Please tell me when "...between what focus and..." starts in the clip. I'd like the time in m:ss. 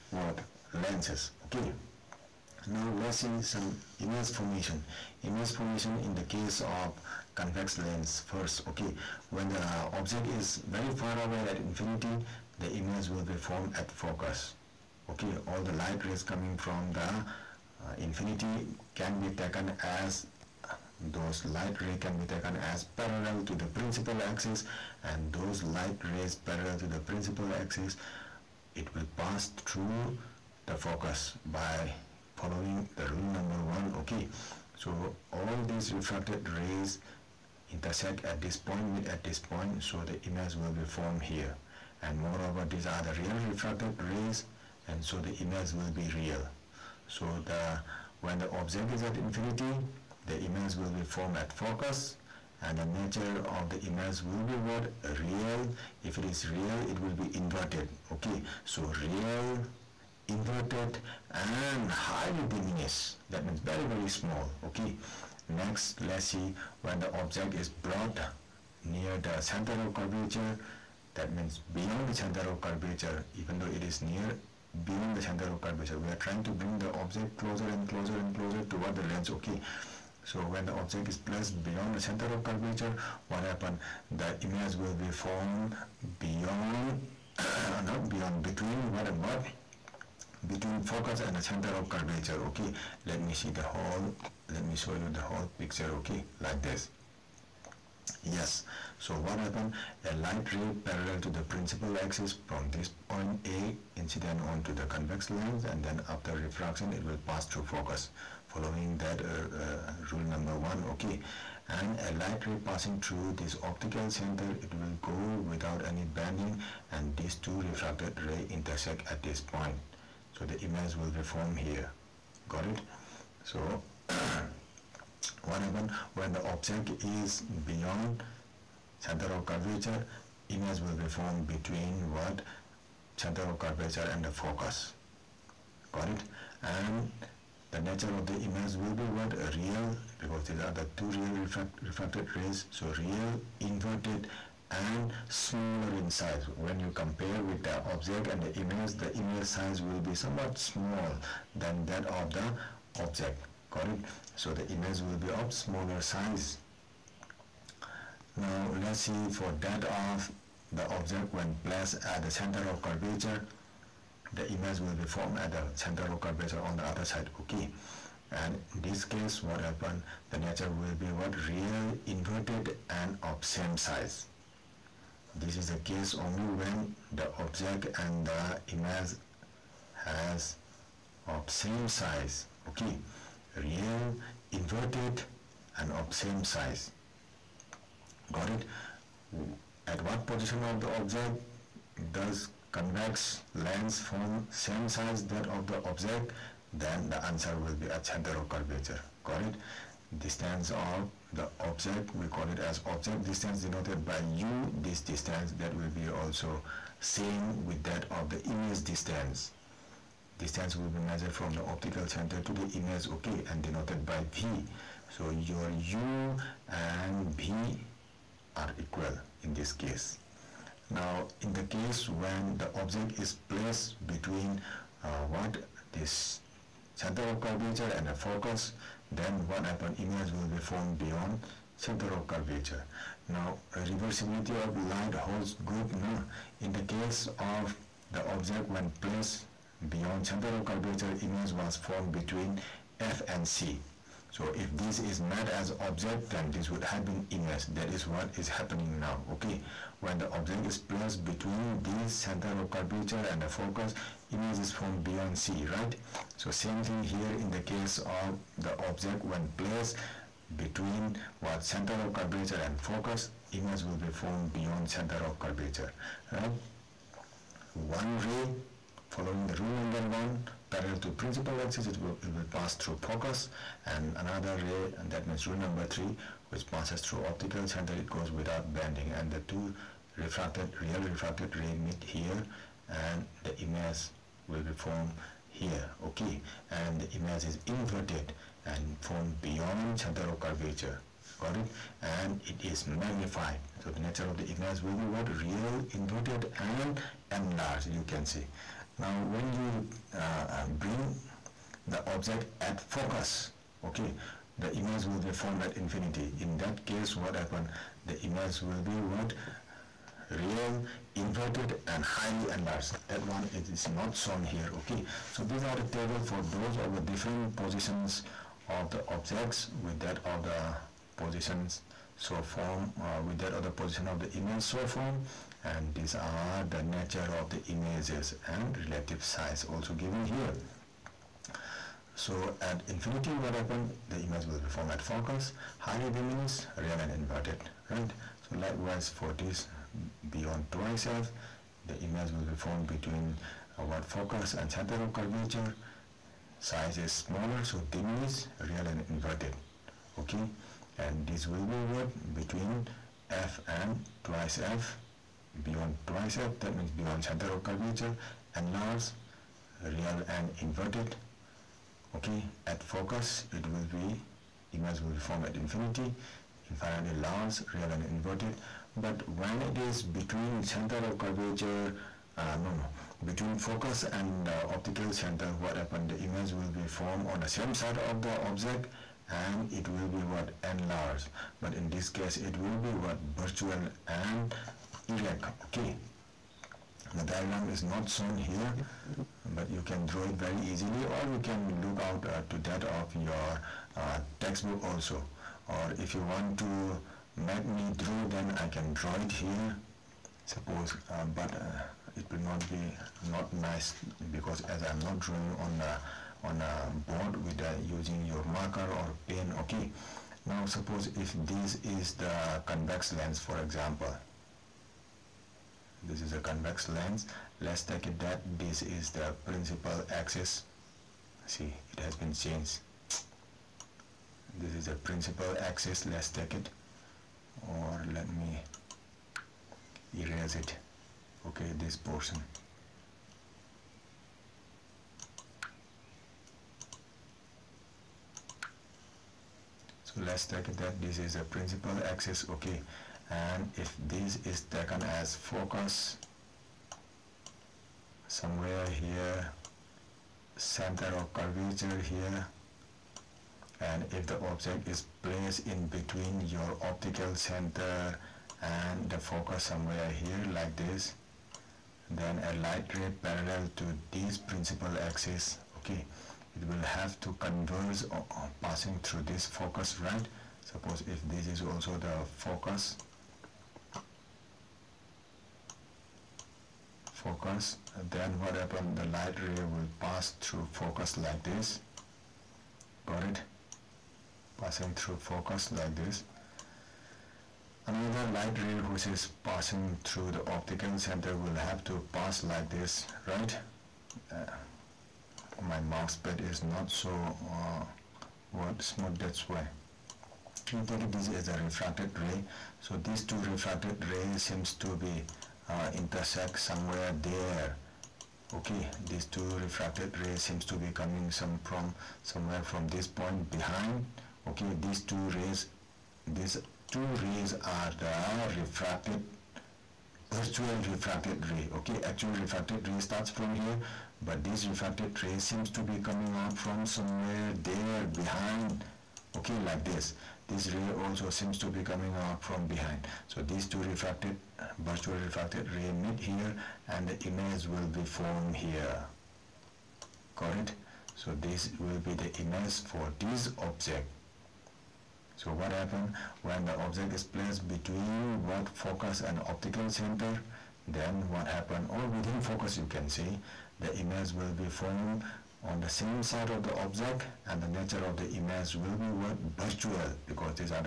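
9:07.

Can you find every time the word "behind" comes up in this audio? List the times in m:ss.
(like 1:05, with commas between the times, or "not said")
8:33, 8:48, 8:52.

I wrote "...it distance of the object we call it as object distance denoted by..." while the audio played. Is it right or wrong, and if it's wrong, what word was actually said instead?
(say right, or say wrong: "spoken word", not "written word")
right.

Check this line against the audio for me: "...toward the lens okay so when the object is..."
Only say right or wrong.
right.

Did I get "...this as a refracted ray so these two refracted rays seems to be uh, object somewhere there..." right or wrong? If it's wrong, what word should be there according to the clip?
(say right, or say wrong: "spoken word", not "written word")
wrong: "intersect", not "object".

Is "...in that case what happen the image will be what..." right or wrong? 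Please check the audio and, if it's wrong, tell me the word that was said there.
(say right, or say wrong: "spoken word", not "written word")
right.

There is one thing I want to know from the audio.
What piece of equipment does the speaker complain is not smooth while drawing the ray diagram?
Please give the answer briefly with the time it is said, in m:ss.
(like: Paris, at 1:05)
mouse pad, at 8:15.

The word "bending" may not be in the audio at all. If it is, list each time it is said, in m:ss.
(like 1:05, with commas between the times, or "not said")
1:56, 4:38.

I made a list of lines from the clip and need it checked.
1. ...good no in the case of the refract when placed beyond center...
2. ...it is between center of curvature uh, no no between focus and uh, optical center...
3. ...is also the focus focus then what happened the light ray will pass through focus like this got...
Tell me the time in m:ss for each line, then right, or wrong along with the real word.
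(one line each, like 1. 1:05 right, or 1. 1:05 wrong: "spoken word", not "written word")
1. 3:55 wrong: "object", not "refract"
2. 6:09 right
3. 7:51 right.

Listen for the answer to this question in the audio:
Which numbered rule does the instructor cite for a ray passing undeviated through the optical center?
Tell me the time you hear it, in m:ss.
4:35.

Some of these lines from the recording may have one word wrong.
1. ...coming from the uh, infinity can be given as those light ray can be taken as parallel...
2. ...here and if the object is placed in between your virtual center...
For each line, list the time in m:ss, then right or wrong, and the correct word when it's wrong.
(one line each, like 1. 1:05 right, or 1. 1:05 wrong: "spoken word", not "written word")
1. 0:16 wrong: "taken", not "given"
2. 7:31 wrong: "optical", not "virtual".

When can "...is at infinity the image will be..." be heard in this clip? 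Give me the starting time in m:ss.
0:48.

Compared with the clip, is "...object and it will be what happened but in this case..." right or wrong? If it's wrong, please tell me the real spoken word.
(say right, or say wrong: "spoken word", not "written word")
wrong: "enlarged", not "happened".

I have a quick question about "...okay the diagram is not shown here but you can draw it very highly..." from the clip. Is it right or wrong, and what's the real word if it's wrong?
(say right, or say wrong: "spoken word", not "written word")
wrong: "easily", not "highly".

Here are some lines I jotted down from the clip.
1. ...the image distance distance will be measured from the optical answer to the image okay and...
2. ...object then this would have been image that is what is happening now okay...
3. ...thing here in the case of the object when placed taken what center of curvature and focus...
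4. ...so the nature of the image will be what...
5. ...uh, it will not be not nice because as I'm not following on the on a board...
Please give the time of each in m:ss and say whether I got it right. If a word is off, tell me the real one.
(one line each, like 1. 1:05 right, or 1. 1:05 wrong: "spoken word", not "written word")
1. 3:28 wrong: "center", not "answer"
2. 4:05 right
3. 4:16 wrong: "between", not "taken"
4. 4:53 right
5. 6:41 wrong: "drawing", not "following".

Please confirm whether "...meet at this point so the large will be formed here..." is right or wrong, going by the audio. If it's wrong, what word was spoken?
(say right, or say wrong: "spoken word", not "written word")
wrong: "image", not "large".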